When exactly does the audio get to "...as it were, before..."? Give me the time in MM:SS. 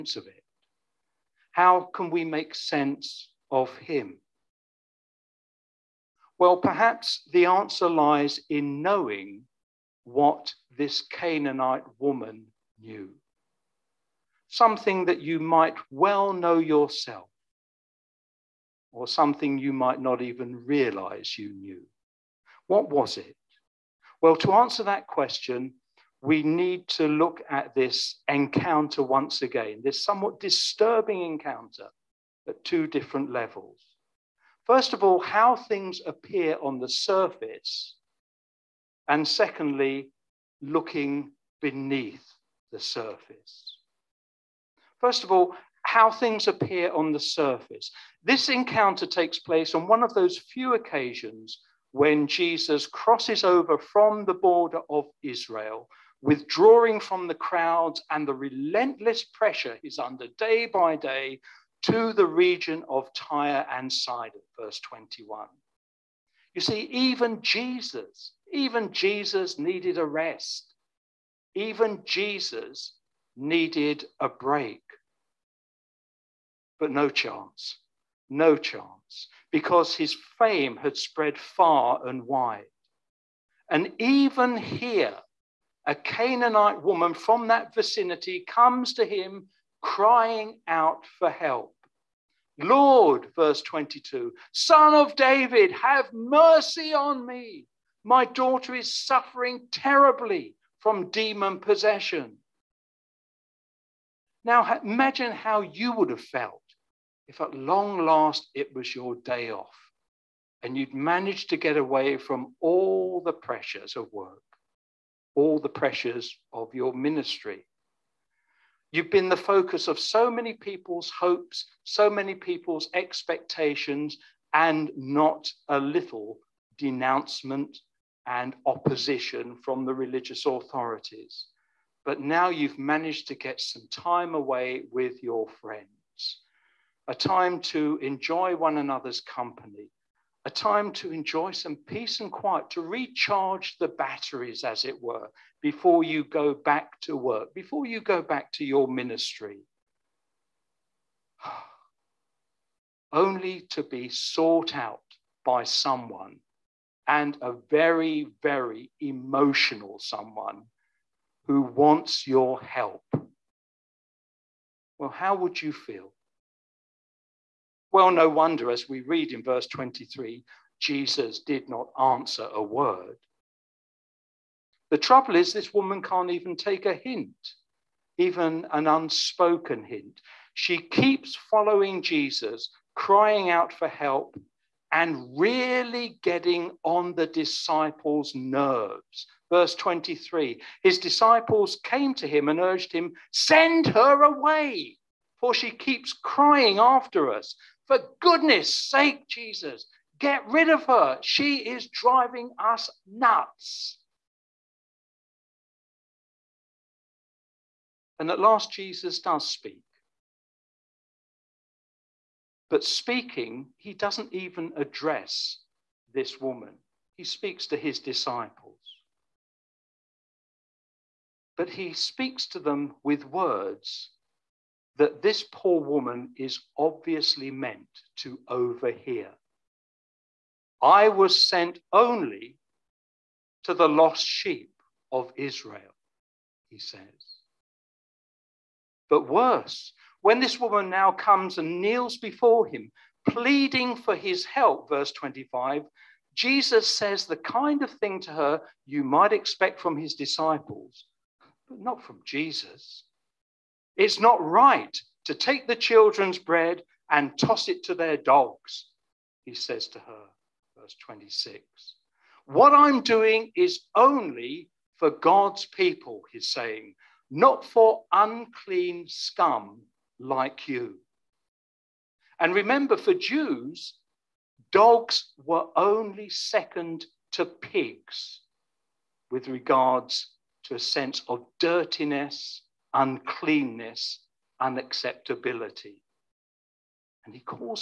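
02:24.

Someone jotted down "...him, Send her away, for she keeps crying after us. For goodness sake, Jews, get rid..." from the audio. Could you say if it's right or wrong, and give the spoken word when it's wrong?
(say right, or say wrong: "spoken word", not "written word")
wrong: "Jesus", not "Jews".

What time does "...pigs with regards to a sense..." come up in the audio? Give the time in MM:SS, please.
04:37.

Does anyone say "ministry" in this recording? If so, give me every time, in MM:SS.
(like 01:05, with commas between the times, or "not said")
01:56, 02:28.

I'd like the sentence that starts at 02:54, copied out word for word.
The trouble is, this woman can't even take a hint, even an unspoken hint.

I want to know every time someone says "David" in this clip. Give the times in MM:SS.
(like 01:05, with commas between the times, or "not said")
01:35.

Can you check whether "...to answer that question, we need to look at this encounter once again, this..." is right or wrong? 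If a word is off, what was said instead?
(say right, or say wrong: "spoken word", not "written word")
right.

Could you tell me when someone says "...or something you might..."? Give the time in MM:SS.
00:18.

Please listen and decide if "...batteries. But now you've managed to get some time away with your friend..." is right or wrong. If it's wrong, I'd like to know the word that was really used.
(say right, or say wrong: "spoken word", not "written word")
wrong: "authorities", not "batteries".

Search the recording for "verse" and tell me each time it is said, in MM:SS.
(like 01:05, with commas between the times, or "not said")
01:04, 01:33, 02:49, 03:09, 04:04, 04:20.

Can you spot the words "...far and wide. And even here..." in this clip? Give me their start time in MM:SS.
01:21.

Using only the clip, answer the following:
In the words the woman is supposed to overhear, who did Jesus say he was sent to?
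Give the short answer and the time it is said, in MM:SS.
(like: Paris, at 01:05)
The lost sheep of Israel, at 03:53.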